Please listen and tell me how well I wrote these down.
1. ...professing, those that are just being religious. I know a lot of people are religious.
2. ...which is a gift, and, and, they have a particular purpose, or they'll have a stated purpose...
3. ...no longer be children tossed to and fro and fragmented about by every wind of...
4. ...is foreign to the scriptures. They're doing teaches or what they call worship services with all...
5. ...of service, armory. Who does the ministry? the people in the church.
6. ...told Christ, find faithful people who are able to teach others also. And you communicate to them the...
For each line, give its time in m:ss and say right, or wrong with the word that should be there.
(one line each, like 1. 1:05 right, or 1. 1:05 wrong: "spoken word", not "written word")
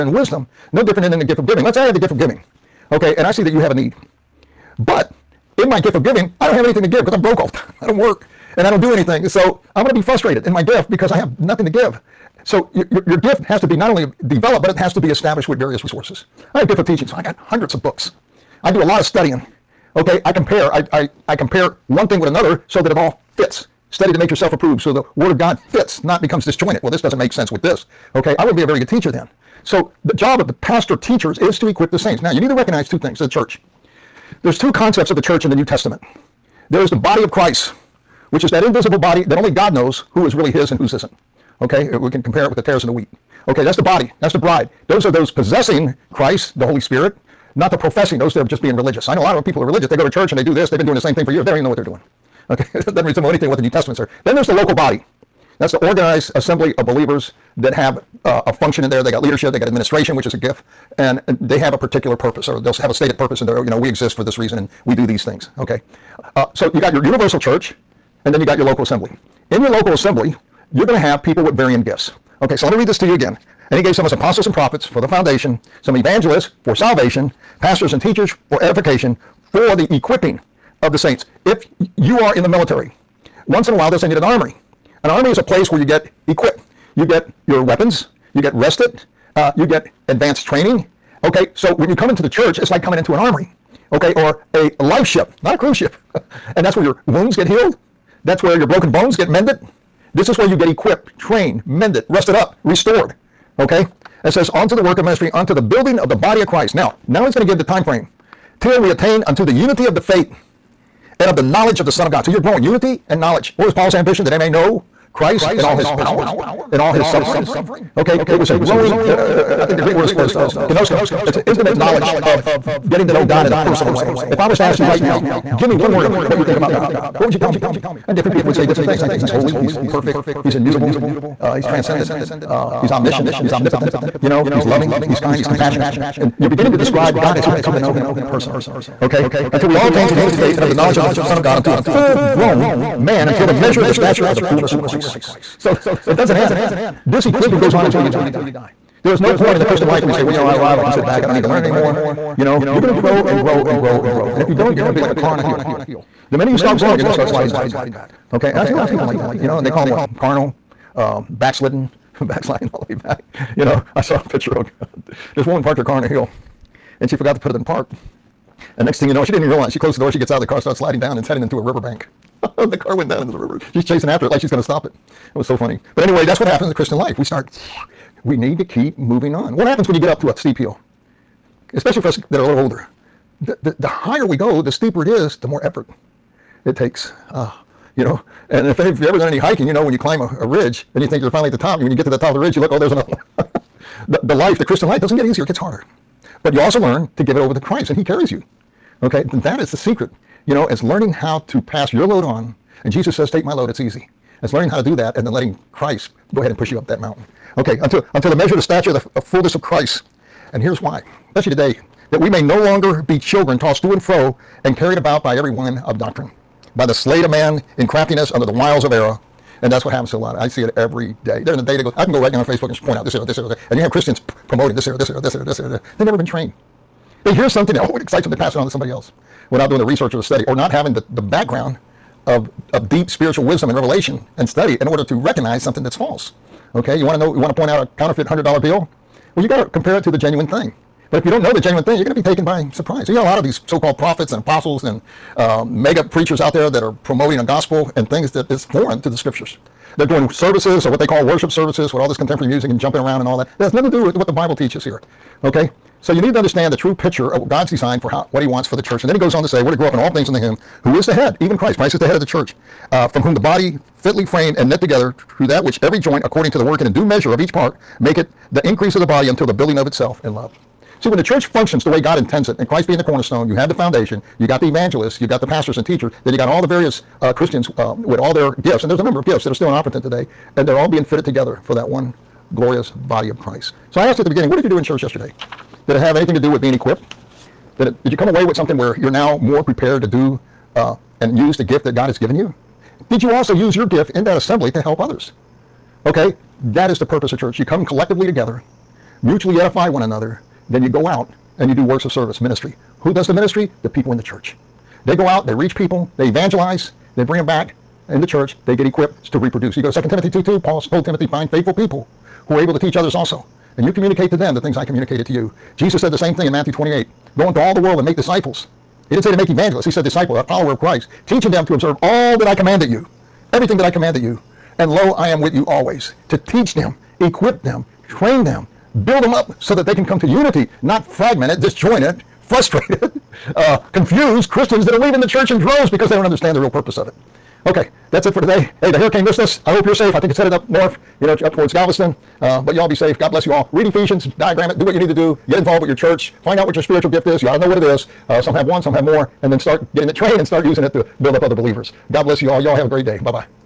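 1. 0:47 right
2. 1:00 right
3. 3:32 wrong: "carried", not "fragmented"
4. 4:08 wrong: "services", not "teaches"
5. 5:02 wrong: "ministry", not "armory"
6. 5:10 wrong: "Timothy", not "Christ".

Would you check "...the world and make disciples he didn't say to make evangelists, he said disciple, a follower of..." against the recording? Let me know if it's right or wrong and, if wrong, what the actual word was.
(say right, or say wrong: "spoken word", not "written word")
right.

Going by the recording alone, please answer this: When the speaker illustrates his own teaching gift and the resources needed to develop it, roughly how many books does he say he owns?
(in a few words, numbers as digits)
hundreds.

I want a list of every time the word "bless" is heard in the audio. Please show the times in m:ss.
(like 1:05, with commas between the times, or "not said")
5:43, 5:52.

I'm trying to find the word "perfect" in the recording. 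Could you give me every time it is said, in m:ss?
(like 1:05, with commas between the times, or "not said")
2:09.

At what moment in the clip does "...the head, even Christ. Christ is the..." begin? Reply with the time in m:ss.
4:21.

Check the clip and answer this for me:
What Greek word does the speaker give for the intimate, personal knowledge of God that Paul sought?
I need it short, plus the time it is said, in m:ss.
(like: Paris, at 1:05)
gnosko, at 2:00.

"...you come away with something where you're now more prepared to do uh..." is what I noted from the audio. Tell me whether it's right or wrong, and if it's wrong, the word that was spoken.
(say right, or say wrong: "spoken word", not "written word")
right.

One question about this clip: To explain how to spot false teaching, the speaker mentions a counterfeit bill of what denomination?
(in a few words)
$100.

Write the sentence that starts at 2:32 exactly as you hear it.
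You know, you're going to grow and grow and grow and grow.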